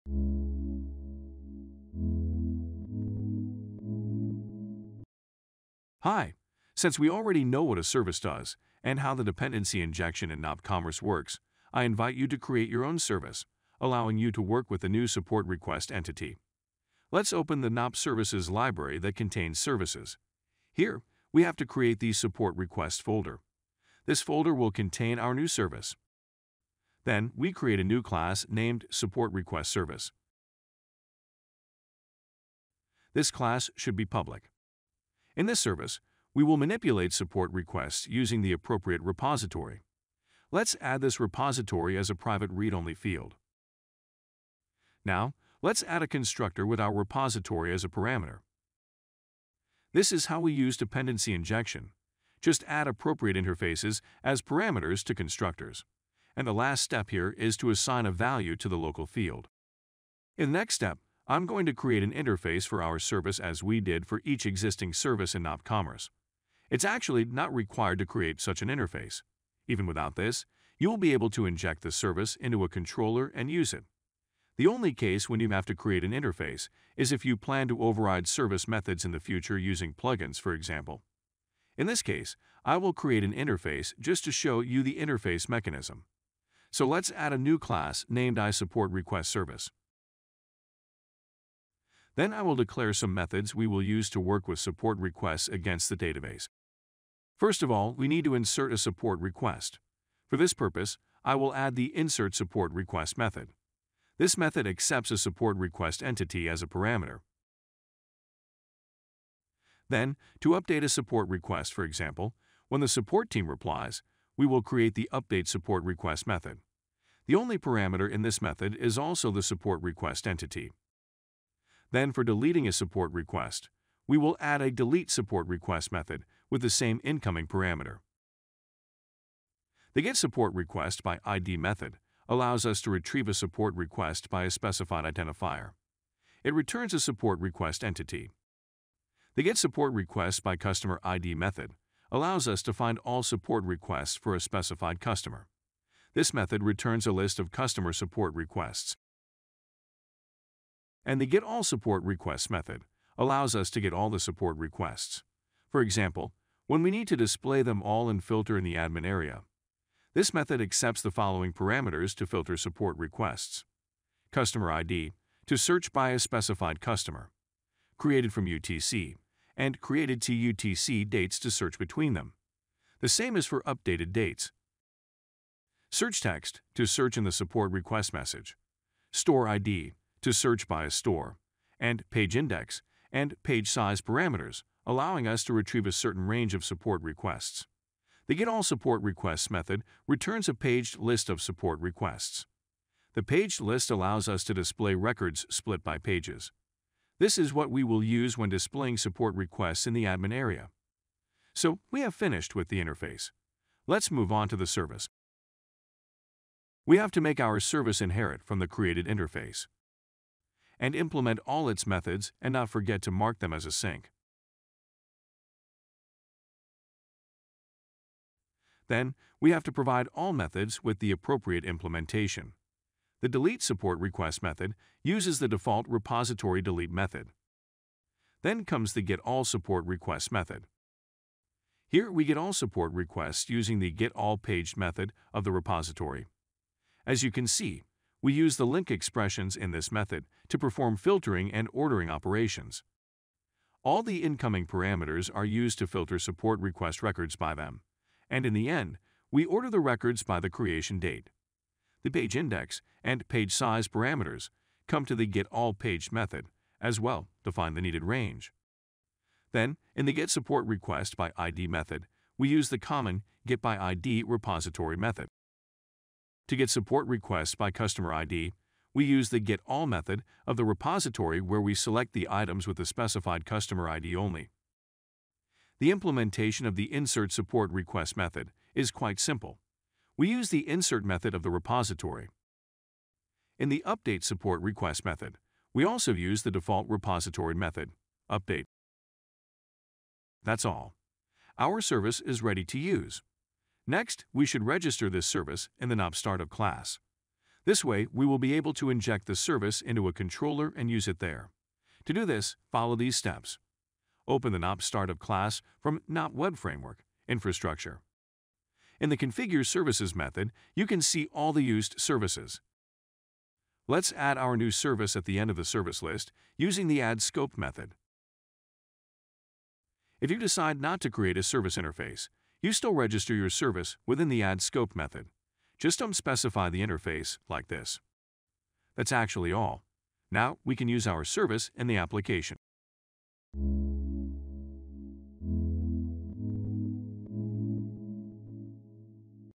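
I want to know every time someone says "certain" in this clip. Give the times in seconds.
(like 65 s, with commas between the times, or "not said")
185 s.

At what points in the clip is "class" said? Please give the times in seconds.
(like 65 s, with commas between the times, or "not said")
28 s, 33 s, 87 s, 296 s, 305 s.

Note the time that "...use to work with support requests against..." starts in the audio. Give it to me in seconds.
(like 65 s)
93 s.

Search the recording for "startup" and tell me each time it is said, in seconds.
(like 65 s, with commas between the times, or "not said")
296 s, 304 s.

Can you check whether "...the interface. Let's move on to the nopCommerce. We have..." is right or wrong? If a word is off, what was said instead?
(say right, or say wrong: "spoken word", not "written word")
wrong: "service", not "nopCommerce".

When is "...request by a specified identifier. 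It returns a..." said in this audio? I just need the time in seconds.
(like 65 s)
133 s.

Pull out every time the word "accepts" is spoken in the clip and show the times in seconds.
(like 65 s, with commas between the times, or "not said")
104 s, 160 s.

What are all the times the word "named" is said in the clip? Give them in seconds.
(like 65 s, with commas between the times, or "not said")
28 s, 88 s.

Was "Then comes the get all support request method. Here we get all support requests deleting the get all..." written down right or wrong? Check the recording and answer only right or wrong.
wrong.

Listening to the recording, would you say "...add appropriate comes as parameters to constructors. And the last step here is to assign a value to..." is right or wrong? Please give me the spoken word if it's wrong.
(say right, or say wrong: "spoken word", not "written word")
wrong: "interfaces", not "comes".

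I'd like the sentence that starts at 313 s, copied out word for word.
Let's add our new service at the end of the service list using the AddScoped method.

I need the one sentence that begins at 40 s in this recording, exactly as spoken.
Let's add this repository as a private read-only field.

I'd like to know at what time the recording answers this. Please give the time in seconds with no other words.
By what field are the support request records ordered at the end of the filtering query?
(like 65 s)
250 s.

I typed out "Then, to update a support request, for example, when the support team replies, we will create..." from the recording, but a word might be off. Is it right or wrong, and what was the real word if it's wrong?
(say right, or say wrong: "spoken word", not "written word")
right.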